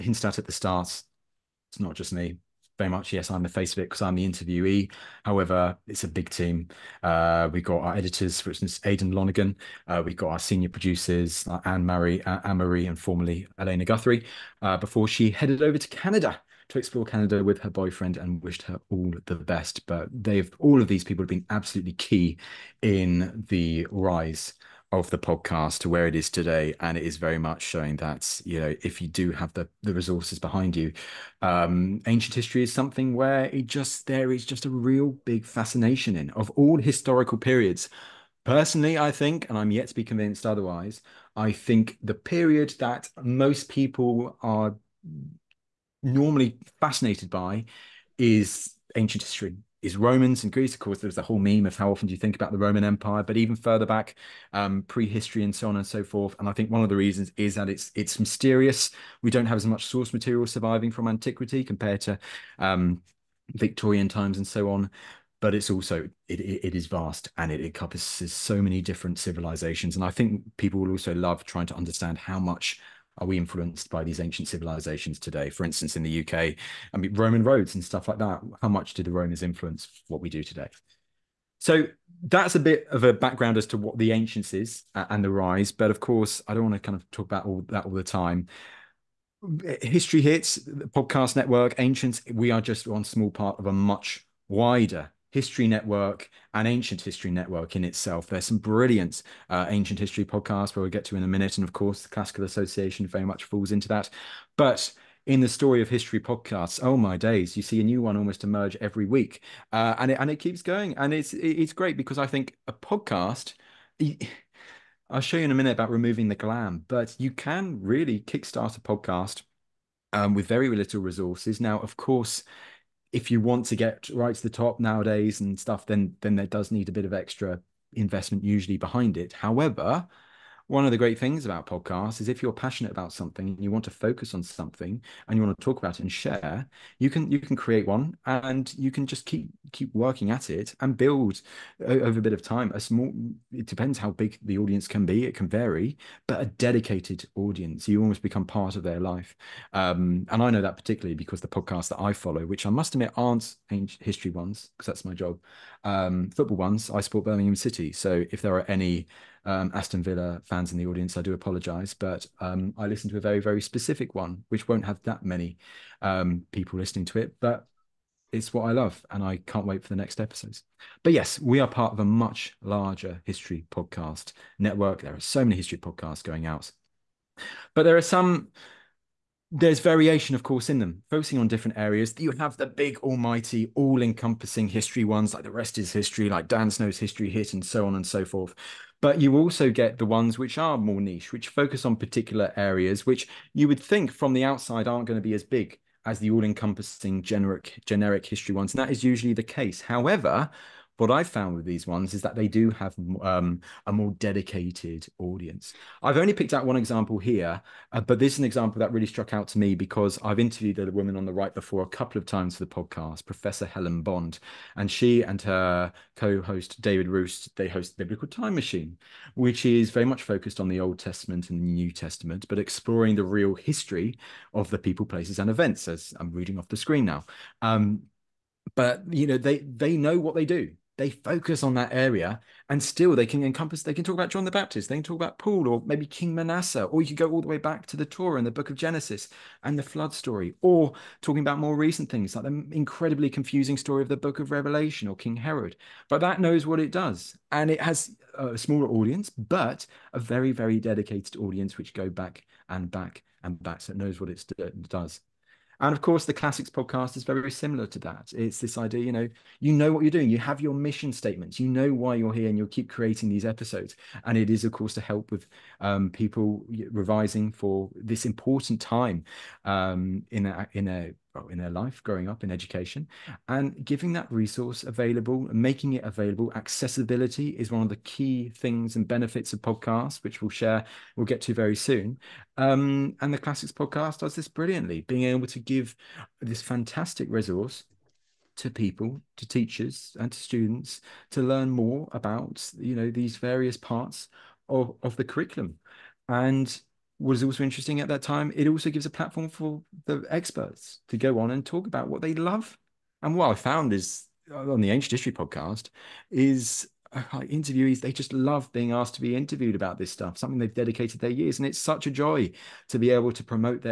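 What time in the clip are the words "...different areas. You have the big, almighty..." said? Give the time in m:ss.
3:01.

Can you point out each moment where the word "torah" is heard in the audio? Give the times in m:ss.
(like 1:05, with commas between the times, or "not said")
3:58.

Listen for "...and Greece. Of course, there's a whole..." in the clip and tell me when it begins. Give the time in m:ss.
0:50.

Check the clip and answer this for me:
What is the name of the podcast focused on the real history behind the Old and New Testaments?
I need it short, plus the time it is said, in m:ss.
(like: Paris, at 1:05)
Biblical Time Machine, at 3:38.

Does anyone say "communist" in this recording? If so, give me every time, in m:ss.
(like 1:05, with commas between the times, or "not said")
not said.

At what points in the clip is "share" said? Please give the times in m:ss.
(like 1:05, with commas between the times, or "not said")
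2:16, 4:40.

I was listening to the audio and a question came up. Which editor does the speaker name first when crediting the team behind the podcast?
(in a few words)
Aidan Lonigan.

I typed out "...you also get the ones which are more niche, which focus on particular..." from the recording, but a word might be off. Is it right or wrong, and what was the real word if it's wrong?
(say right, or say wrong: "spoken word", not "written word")
right.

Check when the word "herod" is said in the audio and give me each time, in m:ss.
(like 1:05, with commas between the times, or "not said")
4:05.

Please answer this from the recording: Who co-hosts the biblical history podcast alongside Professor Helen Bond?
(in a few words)
David Roost.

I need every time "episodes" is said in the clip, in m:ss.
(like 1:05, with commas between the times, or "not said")
2:50, 4:23.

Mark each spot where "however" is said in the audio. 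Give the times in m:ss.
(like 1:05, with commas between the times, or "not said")
0:05, 2:09, 3:19.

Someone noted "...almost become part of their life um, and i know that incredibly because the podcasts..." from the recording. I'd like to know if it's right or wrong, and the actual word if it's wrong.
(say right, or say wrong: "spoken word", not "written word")
wrong: "particularly", not "incredibly".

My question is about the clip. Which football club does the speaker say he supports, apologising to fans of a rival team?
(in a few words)
Birmingham City.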